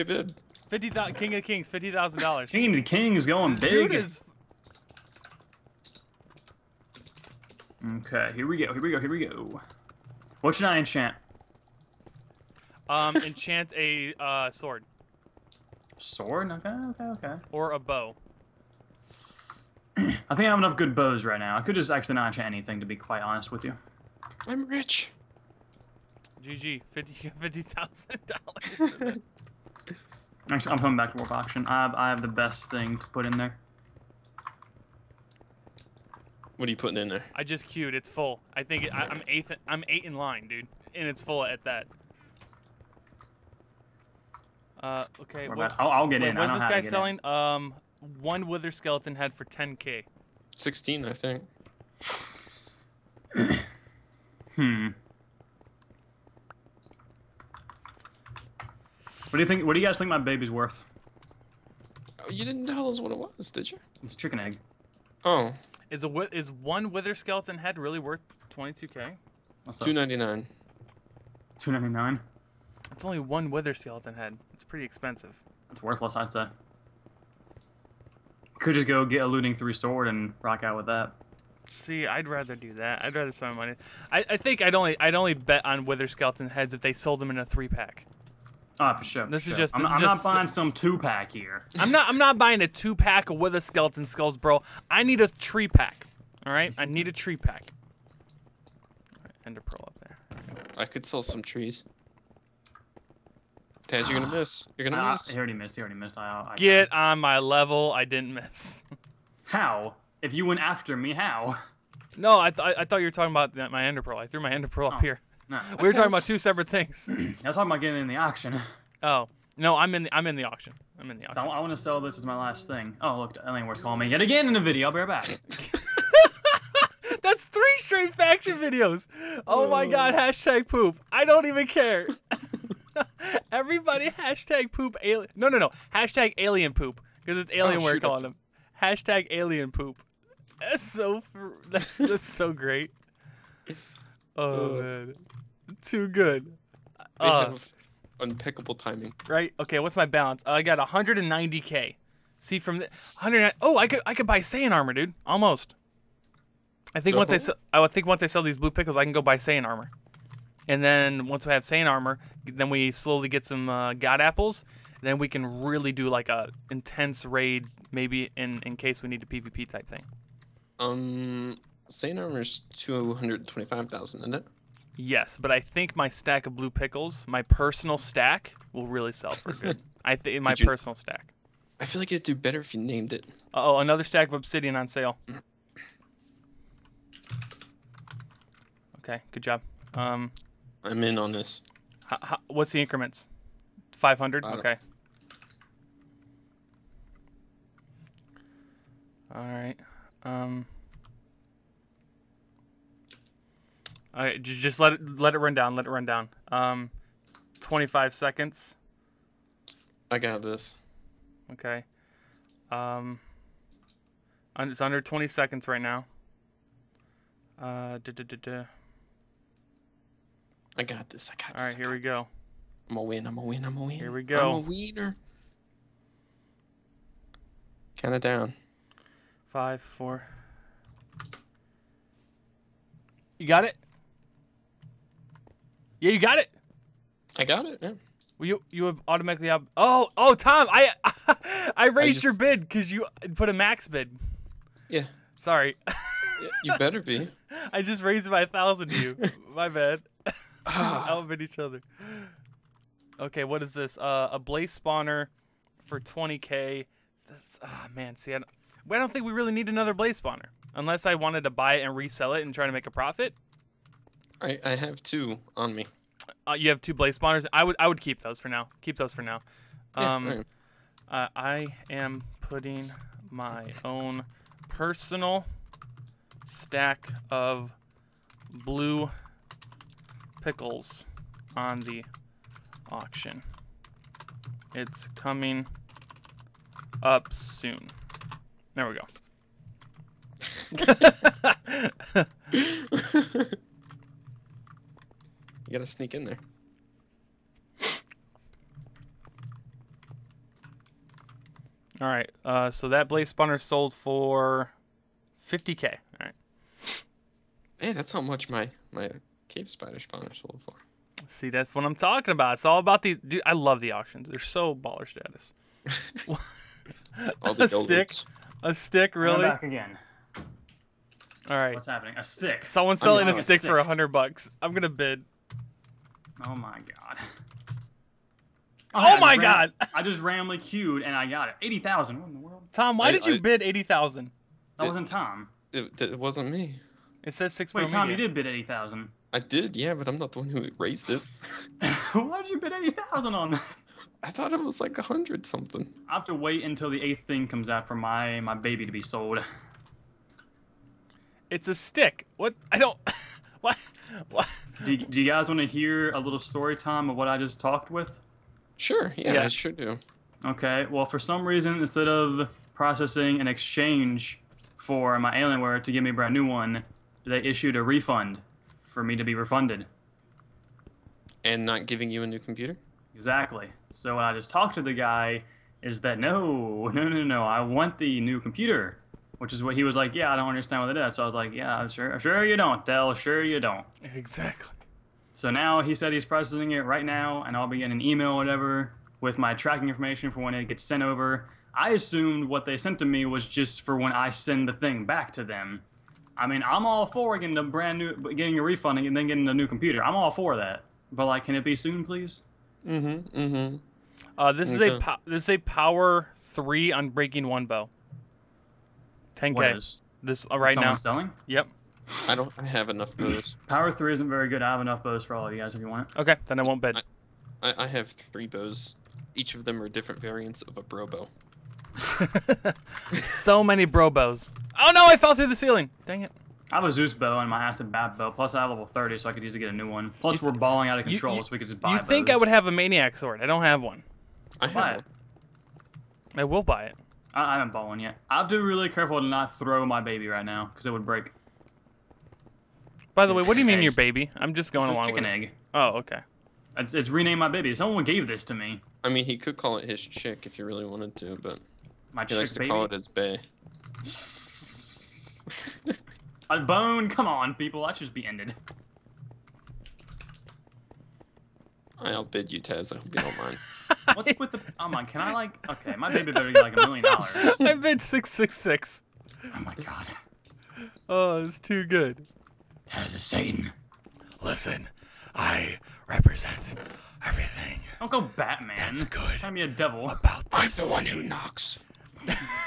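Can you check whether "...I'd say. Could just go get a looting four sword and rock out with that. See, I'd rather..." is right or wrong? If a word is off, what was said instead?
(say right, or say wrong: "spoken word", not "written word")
wrong: "three", not "four".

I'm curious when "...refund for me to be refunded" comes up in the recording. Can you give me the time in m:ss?
6:07.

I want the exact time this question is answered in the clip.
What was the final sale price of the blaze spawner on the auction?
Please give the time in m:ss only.
5:05.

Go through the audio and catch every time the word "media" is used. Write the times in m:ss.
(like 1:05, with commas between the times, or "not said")
5:38.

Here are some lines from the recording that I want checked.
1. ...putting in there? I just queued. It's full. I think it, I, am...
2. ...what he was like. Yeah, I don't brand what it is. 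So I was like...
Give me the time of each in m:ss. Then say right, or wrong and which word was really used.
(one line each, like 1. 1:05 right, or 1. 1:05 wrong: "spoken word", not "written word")
1. 0:36 right
2. 6:19 wrong: "understand", not "brand".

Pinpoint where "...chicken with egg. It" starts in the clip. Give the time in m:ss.
7:25.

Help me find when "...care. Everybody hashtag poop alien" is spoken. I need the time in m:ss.
2:11.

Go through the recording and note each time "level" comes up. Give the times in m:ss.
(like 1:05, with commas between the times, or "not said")
1:47, 7:08.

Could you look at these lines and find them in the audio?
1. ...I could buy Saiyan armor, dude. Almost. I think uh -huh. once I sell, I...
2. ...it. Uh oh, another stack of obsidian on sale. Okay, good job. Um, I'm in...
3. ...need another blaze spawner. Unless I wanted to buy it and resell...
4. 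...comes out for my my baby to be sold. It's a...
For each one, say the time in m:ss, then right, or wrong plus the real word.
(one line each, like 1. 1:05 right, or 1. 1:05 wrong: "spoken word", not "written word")
1. 2:34 right
2. 3:03 right
3. 4:19 right
4. 5:47 right.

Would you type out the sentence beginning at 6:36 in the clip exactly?
I mean, I'm all for getting a brand new, getting a refund and then getting a new computer.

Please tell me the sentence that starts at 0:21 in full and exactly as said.
I could just actually not enchant anything, to be quite honest with you.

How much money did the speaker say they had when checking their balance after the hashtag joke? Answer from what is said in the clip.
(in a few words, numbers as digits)
190k.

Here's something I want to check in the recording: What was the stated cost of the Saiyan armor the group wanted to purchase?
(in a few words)
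225,000.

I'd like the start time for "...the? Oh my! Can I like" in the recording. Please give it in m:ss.
7:44.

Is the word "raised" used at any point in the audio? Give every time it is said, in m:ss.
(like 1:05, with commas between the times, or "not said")
4:01, 4:08, 5:40.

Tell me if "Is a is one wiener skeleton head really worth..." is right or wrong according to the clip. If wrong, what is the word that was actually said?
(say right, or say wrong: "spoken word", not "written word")
wrong: "wither", not "wiener".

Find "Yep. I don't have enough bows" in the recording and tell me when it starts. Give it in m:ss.
6:51.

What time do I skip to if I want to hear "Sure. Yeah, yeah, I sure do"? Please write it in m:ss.
5:58.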